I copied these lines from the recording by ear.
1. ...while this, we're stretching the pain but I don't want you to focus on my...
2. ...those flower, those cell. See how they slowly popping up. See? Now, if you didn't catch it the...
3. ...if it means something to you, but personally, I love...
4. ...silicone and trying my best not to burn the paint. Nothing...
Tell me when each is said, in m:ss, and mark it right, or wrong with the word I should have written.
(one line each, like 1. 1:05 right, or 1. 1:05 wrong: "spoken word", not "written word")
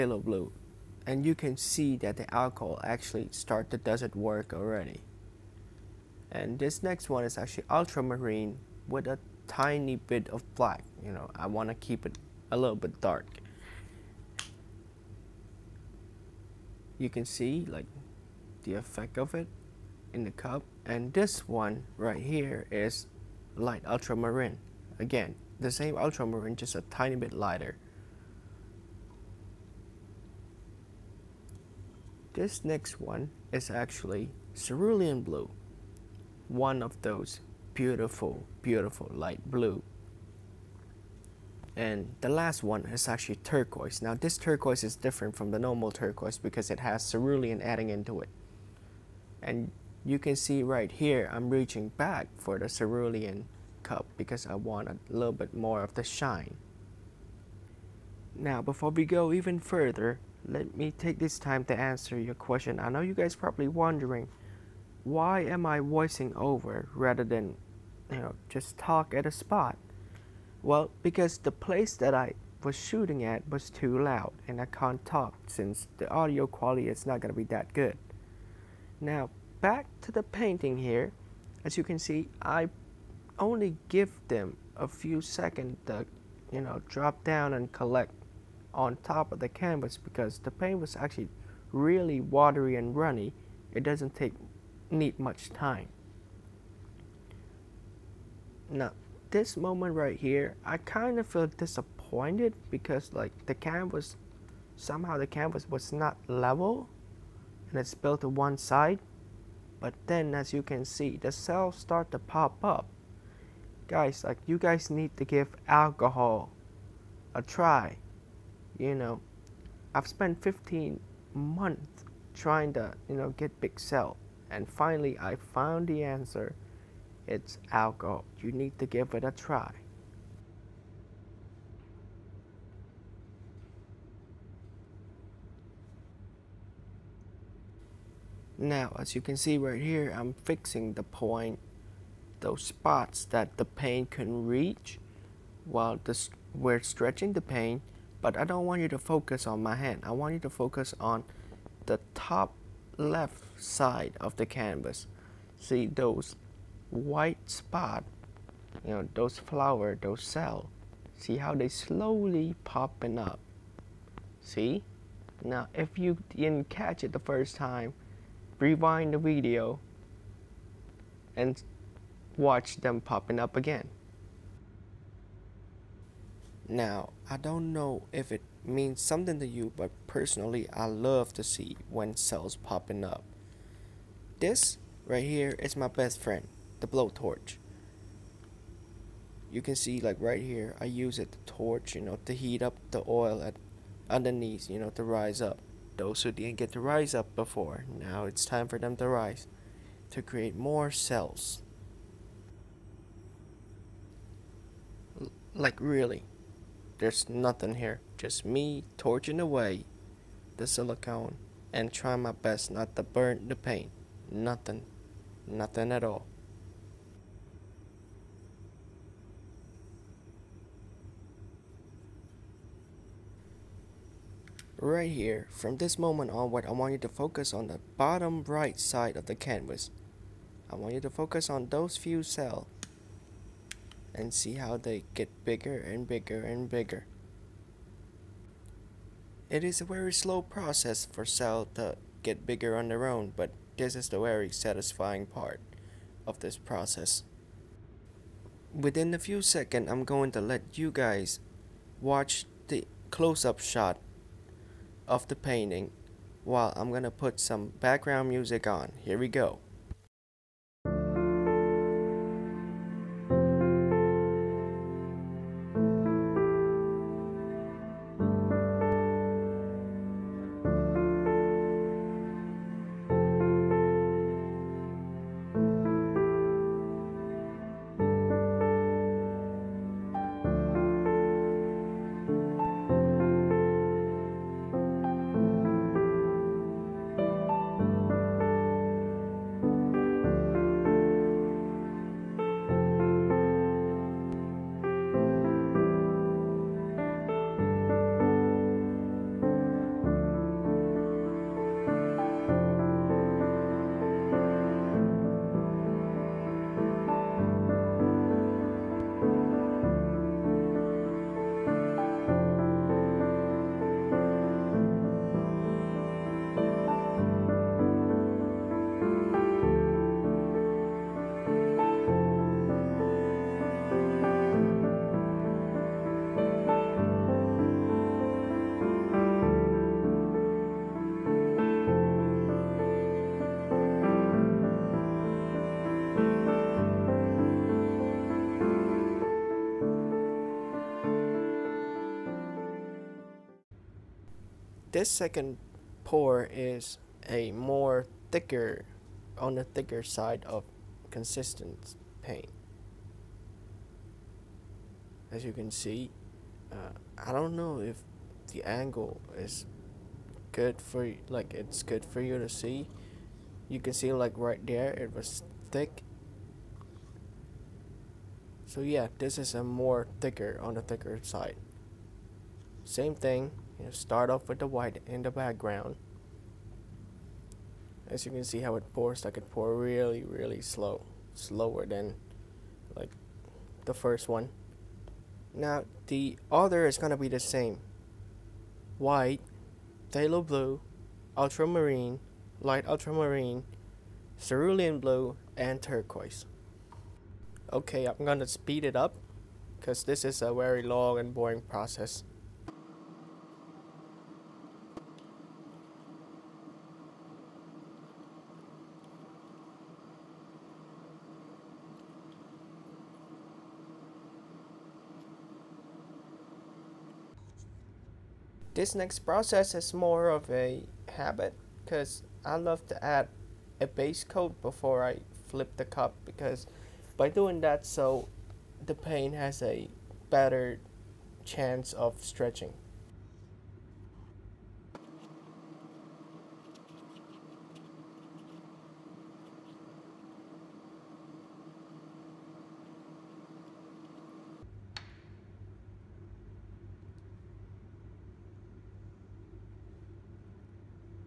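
1. 2:25 right
2. 2:39 right
3. 2:58 right
4. 3:30 right.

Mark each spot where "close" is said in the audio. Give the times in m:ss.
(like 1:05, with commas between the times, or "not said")
4:13.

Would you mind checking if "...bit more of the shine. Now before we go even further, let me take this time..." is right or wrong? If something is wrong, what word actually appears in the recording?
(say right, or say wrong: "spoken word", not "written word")
right.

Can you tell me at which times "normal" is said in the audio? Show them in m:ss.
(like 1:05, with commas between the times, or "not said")
0:45.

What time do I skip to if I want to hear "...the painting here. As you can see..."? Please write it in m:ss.
1:20.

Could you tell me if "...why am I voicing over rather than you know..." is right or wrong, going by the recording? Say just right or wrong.
right.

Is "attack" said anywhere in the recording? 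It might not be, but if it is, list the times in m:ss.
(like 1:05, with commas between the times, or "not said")
not said.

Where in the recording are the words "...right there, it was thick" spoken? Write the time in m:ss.
6:04.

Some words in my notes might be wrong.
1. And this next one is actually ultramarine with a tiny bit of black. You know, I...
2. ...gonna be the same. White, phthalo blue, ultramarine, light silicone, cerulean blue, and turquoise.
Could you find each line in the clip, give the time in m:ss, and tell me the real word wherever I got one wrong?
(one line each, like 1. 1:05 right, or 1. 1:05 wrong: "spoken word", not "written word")
1. 0:06 right
2. 6:26 wrong: "ultramarine", not "silicone".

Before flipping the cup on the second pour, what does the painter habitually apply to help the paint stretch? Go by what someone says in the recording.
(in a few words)
Base coat.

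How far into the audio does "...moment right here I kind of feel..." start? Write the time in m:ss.
1:39.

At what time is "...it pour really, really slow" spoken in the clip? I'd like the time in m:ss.
6:19.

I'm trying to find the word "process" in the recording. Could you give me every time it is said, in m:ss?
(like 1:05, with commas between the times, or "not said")
4:00, 4:06, 6:41, 6:59.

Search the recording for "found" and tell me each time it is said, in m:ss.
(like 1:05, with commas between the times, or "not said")
2:05.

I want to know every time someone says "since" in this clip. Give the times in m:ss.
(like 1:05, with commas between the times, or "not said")
1:15.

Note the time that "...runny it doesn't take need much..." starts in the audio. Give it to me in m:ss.
1:32.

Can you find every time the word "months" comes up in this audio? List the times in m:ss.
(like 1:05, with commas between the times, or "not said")
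2:01.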